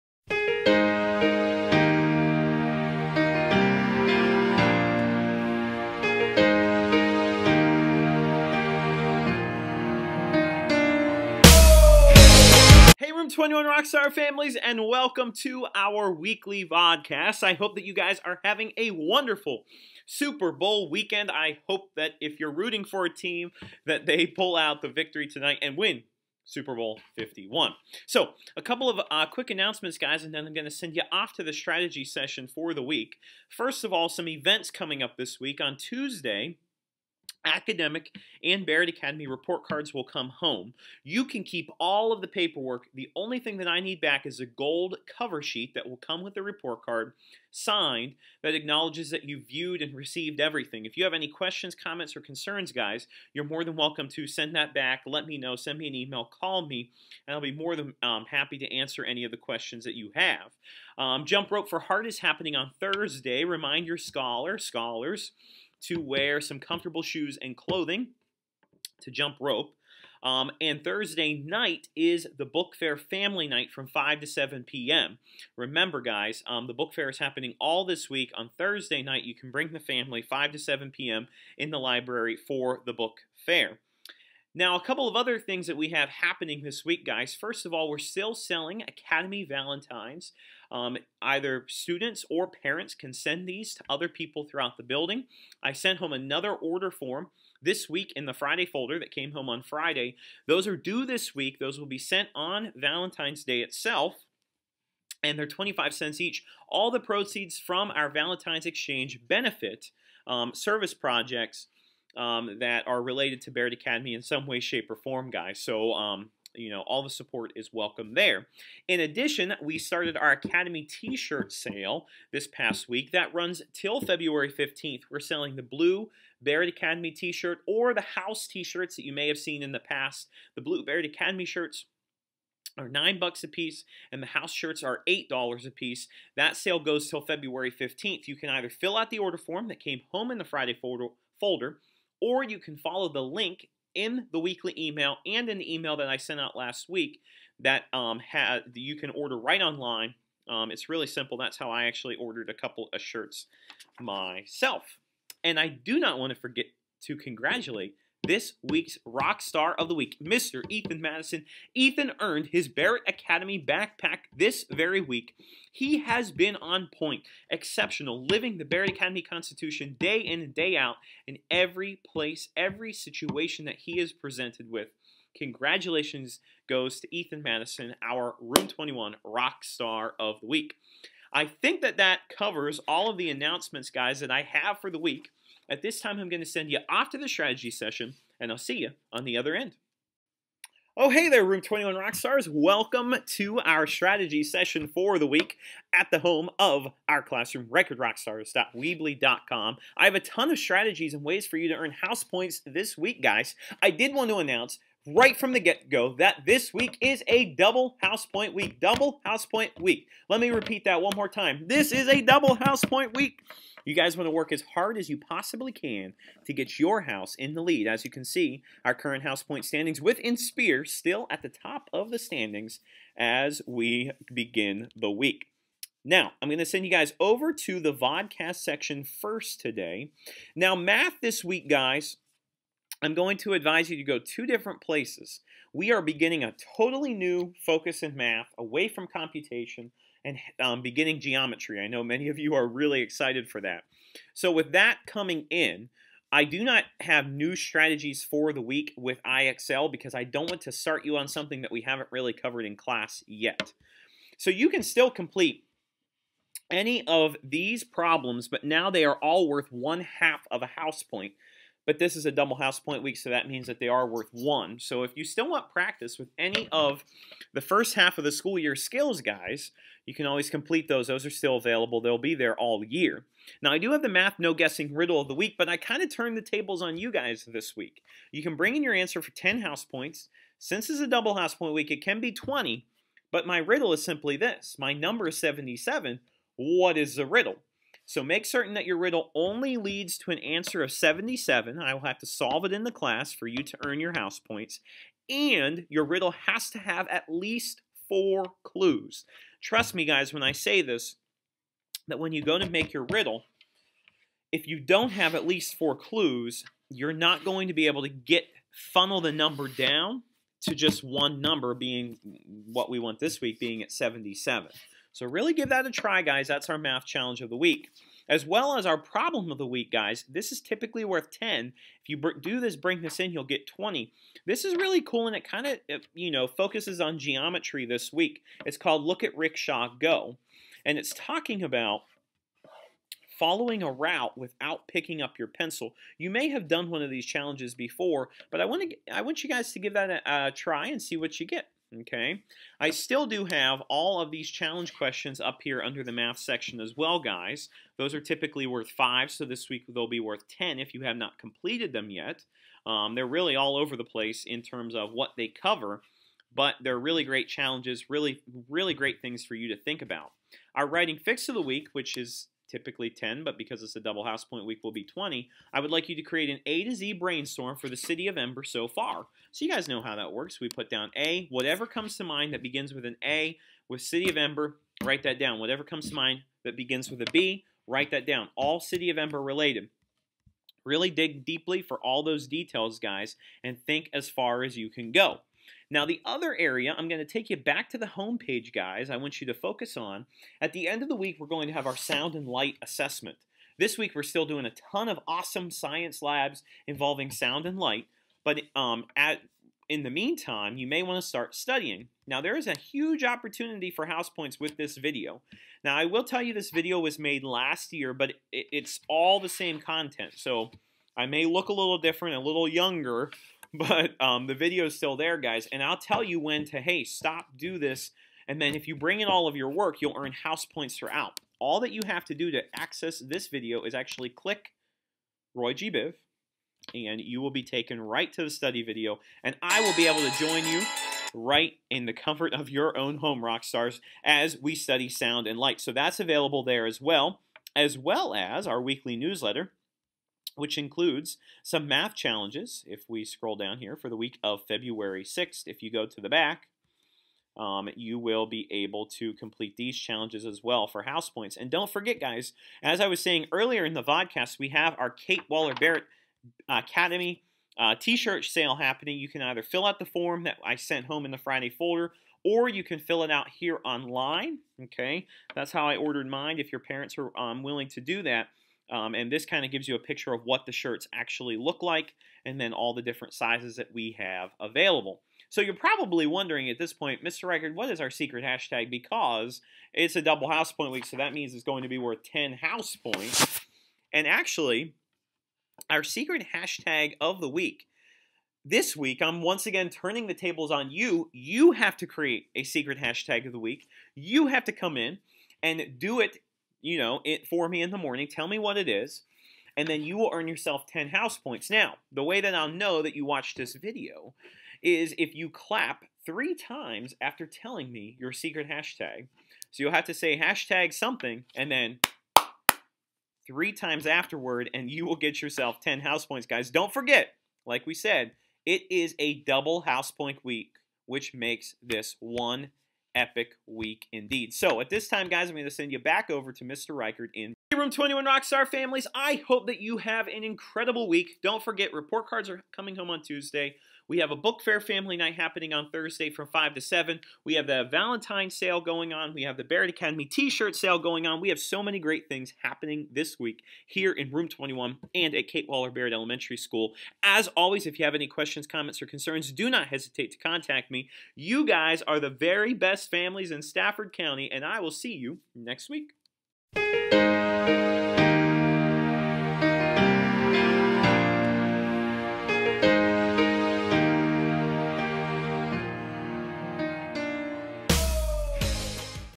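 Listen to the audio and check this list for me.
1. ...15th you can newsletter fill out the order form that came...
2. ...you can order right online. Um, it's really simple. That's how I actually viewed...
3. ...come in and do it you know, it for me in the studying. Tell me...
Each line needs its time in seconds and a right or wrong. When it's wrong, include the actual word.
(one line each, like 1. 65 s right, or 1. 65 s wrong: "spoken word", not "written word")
1. 137 s wrong: "either", not "newsletter"
2. 148 s wrong: "ordered", not "viewed"
3. 494 s wrong: "morning", not "studying".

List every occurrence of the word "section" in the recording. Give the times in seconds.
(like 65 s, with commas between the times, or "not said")
228 s, 346 s.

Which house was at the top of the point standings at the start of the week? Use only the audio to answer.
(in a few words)
Spear.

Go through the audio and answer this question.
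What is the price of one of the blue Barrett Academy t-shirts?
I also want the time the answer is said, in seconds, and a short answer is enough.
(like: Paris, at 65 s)
$9, at 132 s.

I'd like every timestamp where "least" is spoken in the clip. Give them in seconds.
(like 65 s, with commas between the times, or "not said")
297 s, 305 s.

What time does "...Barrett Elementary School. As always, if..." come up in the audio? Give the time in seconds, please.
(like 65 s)
545 s.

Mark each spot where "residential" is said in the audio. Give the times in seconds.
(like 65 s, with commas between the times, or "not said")
not said.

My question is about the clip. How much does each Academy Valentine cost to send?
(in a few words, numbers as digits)
25 cents.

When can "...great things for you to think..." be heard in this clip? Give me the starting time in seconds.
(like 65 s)
358 s.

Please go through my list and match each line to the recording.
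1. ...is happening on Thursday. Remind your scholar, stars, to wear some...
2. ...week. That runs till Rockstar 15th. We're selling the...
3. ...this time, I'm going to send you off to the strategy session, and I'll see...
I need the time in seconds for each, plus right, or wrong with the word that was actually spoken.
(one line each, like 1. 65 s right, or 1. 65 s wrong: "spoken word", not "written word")
1. 62 s wrong: "scholars", not "stars"
2. 122 s wrong: "February", not "Rockstar"
3. 185 s right.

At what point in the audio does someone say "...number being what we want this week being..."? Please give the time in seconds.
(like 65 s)
311 s.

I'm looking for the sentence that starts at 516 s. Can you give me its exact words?
Don't forget, like we said, it is a double house point week, which makes this one epic week indeed.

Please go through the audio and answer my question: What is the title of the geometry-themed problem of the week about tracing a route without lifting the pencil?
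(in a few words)
Look at Rickshaw Go.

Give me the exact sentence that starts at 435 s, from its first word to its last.
So that's available there as well, as well as our weekly newsletter, which includes some math challenges.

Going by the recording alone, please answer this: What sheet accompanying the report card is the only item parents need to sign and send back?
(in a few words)
gold cover sheet.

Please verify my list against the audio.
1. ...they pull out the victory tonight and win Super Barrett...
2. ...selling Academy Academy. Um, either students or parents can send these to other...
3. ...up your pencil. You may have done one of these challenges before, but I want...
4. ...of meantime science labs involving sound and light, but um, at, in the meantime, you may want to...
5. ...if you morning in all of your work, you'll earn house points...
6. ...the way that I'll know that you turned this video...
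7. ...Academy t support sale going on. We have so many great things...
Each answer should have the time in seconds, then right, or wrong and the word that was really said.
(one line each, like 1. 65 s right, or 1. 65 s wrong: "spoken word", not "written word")
1. 24 s wrong: "Bowl", not "Barrett"
2. 88 s wrong: "Valentines", not "Academy"
3. 335 s right
4. 395 s wrong: "awesome", not "meantime"
5. 418 s wrong: "bring", not "morning"
6. 502 s wrong: "watched", not "turned"
7. 539 s wrong: "shirt", not "support".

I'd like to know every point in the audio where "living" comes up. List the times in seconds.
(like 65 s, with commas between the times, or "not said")
168 s.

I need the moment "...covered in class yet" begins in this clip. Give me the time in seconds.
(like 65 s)
252 s.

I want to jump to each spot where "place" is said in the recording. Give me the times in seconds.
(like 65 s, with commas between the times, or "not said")
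172 s, 234 s, 354 s.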